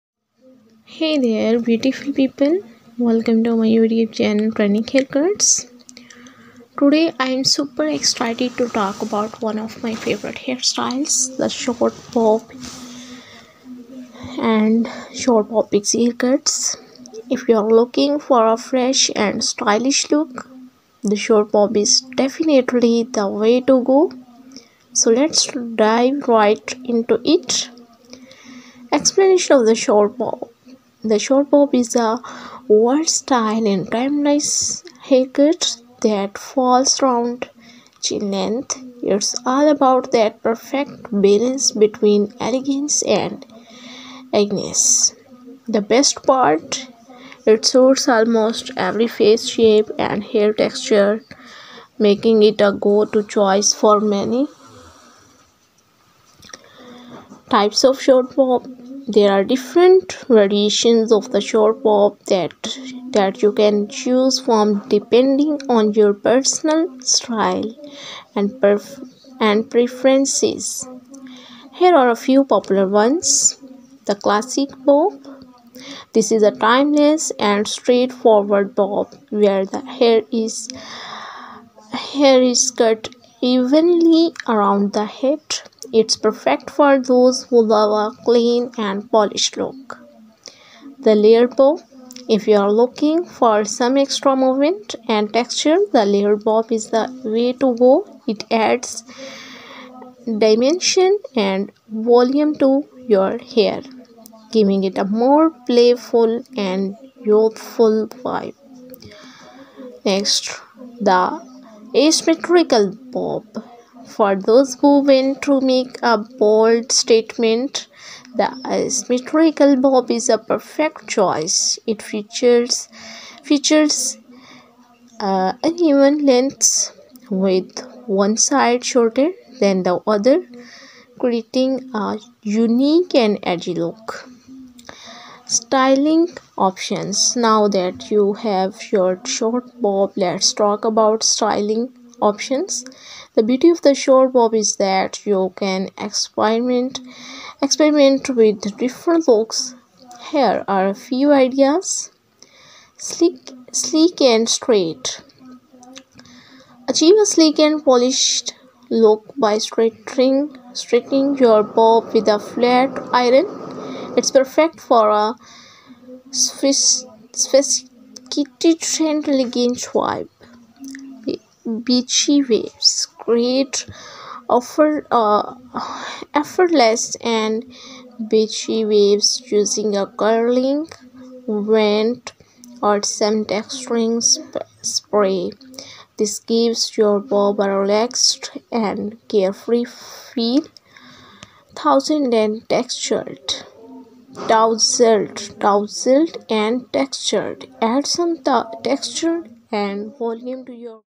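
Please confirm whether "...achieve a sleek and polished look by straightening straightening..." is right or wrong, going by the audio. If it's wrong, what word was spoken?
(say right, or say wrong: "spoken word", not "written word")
right.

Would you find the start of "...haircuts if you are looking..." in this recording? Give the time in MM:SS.
00:16.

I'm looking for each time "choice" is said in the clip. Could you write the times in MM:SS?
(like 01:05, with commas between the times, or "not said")
00:53, 02:01.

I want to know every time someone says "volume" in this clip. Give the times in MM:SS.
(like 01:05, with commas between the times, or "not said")
01:41, 03:20.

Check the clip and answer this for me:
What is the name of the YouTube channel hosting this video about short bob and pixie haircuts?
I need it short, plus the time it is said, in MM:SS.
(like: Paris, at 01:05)
Training Haircuts, at 00:04.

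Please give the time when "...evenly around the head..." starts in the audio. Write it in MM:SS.
01:23.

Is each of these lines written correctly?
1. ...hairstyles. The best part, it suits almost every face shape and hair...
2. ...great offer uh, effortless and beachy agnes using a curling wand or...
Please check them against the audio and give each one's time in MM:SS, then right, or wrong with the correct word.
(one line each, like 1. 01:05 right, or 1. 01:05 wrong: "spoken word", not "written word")
1. 00:44 wrong: "agnes", not "hairstyles"
2. 02:53 wrong: "waves", not "agnes".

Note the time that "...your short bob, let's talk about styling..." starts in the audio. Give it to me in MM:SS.
02:18.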